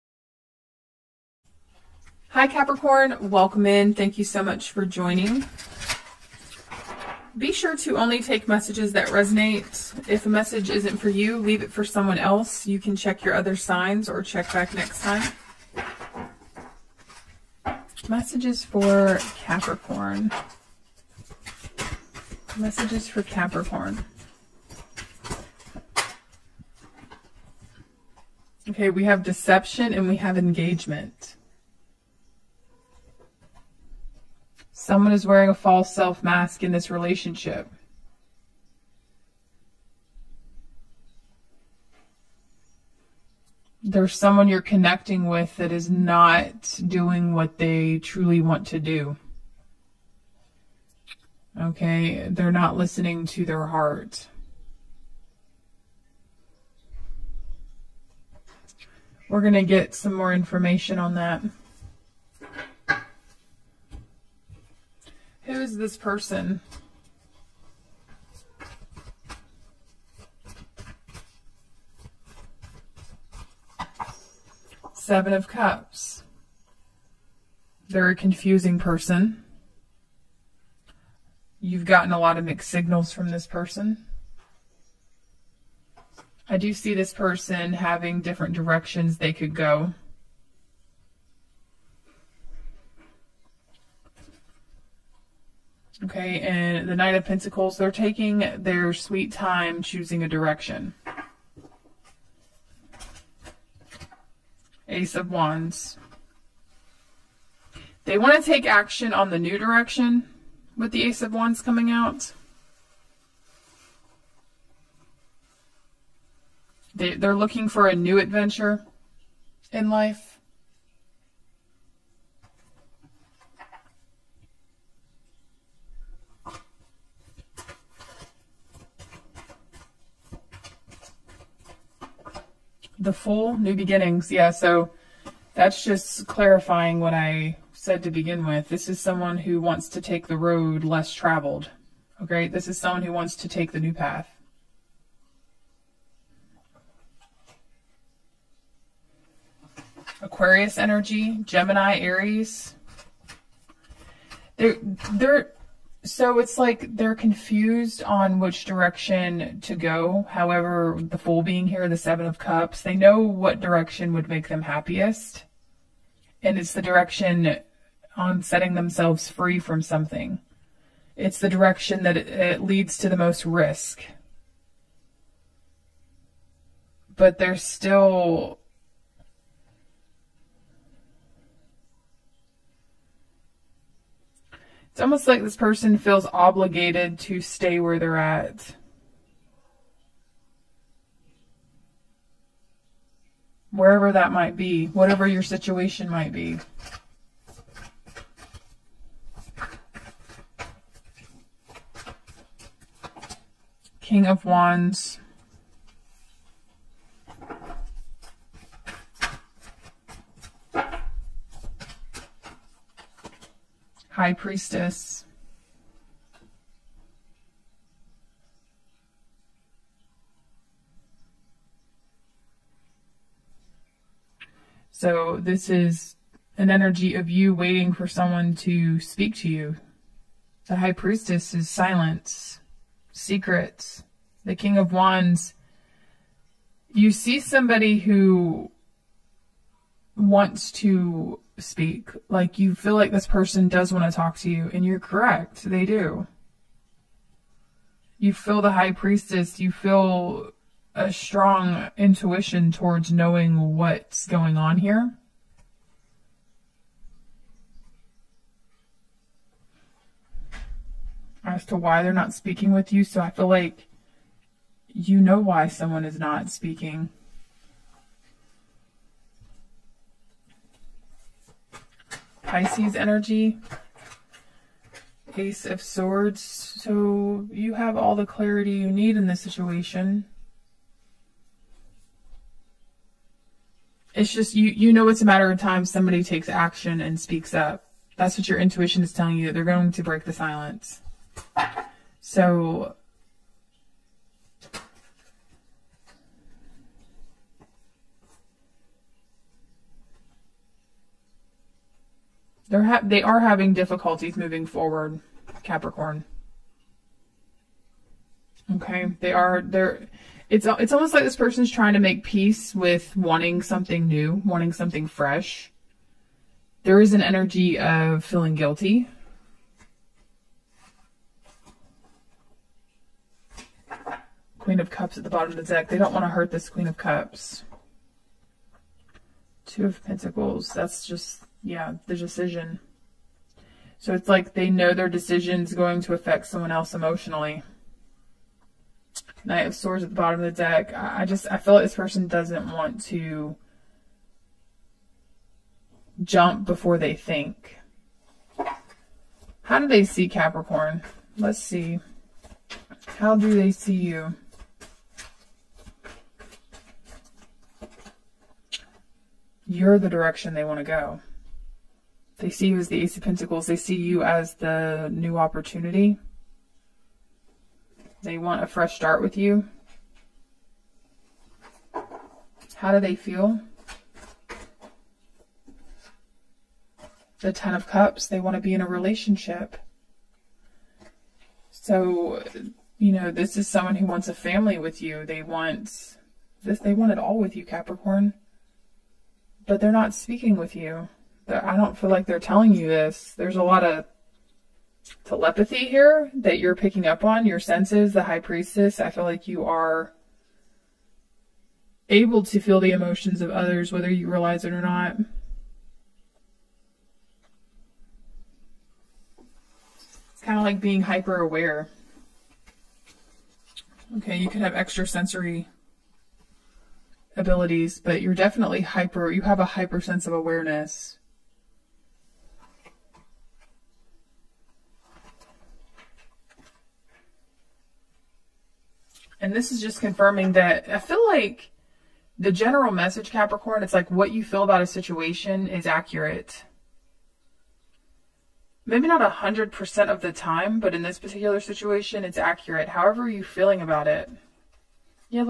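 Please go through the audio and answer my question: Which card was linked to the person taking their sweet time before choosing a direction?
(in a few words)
Knight of Pentacles.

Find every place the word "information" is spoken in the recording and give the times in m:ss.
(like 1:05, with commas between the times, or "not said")
1:00.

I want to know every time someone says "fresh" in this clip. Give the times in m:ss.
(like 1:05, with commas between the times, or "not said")
5:15, 6:08.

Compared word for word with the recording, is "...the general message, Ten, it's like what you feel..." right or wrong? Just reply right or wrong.
wrong.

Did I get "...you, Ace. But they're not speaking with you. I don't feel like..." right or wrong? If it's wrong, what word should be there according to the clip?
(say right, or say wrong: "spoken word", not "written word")
wrong: "Capricorn", not "Ace".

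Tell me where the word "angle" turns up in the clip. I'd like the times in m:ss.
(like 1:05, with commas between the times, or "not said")
not said.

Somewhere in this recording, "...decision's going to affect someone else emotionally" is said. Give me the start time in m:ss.
5:35.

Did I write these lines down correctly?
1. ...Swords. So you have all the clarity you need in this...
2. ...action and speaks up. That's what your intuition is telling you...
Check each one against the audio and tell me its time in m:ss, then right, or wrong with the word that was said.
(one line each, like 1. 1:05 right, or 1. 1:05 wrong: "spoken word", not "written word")
1. 4:35 right
2. 4:46 right.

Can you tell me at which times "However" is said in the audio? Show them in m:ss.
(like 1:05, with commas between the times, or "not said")
2:40, 7:22.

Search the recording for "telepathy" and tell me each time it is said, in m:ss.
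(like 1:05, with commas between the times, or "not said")
6:35.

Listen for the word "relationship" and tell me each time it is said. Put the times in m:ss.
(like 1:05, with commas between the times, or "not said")
0:36, 6:18.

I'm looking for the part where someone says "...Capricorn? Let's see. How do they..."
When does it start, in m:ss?
5:50.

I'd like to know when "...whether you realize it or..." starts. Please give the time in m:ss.
6:43.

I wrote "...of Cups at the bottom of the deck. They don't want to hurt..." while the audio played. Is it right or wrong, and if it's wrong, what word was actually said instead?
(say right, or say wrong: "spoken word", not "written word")
right.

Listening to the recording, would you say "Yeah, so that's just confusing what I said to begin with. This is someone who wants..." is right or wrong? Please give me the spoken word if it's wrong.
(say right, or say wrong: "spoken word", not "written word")
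wrong: "clarifying", not "confusing".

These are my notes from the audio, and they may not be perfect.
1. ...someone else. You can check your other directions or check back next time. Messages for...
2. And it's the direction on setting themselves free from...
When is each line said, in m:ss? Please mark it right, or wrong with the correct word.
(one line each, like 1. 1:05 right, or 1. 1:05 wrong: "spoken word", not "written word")
1. 0:11 wrong: "signs", not "directions"
2. 2:46 right.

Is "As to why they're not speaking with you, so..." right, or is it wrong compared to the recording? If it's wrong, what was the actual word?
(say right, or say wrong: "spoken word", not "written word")
right.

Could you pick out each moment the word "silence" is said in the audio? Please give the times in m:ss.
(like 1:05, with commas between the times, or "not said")
3:51, 4:50.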